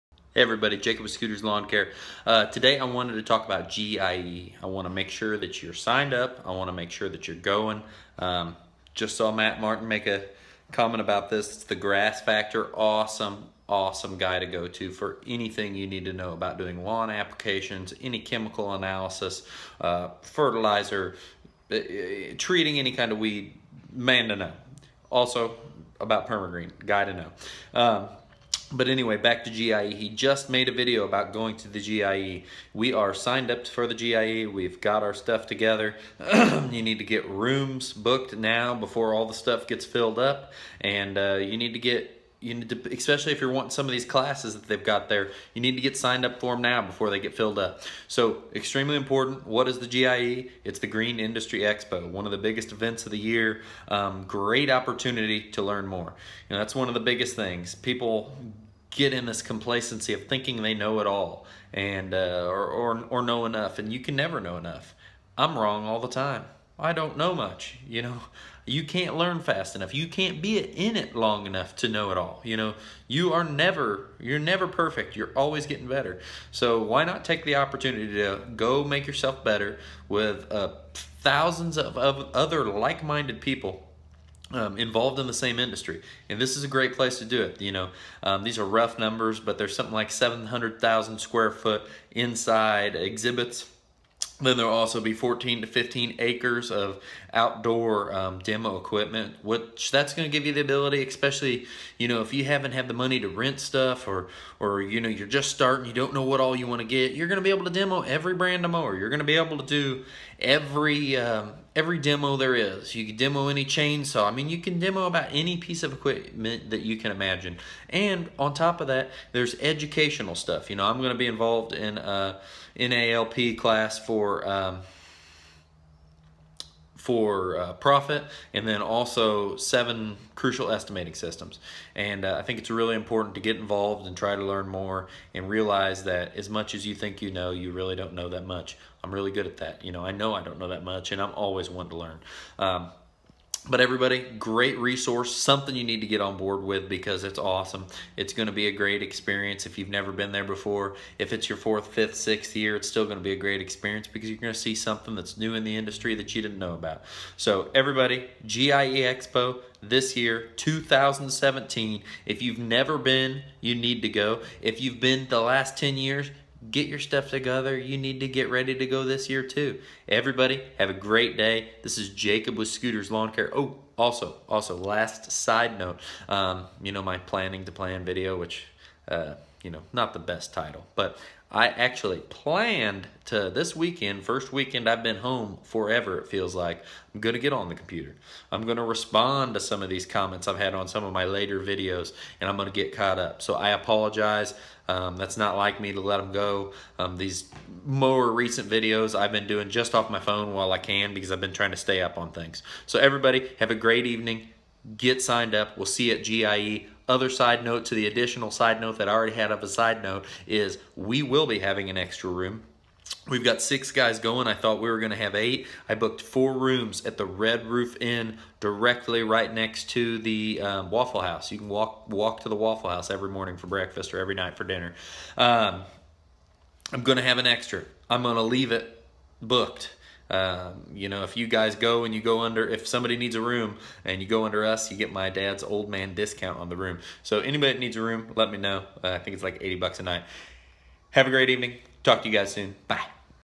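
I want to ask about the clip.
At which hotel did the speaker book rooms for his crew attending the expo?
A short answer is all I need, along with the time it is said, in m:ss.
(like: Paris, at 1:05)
Red Roof Inn, at 3:37.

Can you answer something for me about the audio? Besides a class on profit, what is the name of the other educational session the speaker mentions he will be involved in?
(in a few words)
Seven crucial estimating systems.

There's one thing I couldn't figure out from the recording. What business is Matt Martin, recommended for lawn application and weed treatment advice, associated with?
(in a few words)
The Grass Factor.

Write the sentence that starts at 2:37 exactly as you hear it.
So everybody, GIE Expo this year, 2017.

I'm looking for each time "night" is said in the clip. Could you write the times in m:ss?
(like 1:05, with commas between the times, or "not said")
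3:44, 4:00.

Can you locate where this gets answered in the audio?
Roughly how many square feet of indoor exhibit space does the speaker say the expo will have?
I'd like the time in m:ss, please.
1:30.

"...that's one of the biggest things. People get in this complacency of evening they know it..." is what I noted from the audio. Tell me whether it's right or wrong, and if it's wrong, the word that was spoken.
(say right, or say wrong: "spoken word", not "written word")
wrong: "thinking", not "evening".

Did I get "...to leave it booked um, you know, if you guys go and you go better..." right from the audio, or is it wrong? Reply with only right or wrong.
wrong.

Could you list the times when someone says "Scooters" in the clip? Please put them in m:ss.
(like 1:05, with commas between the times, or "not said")
0:01, 2:52.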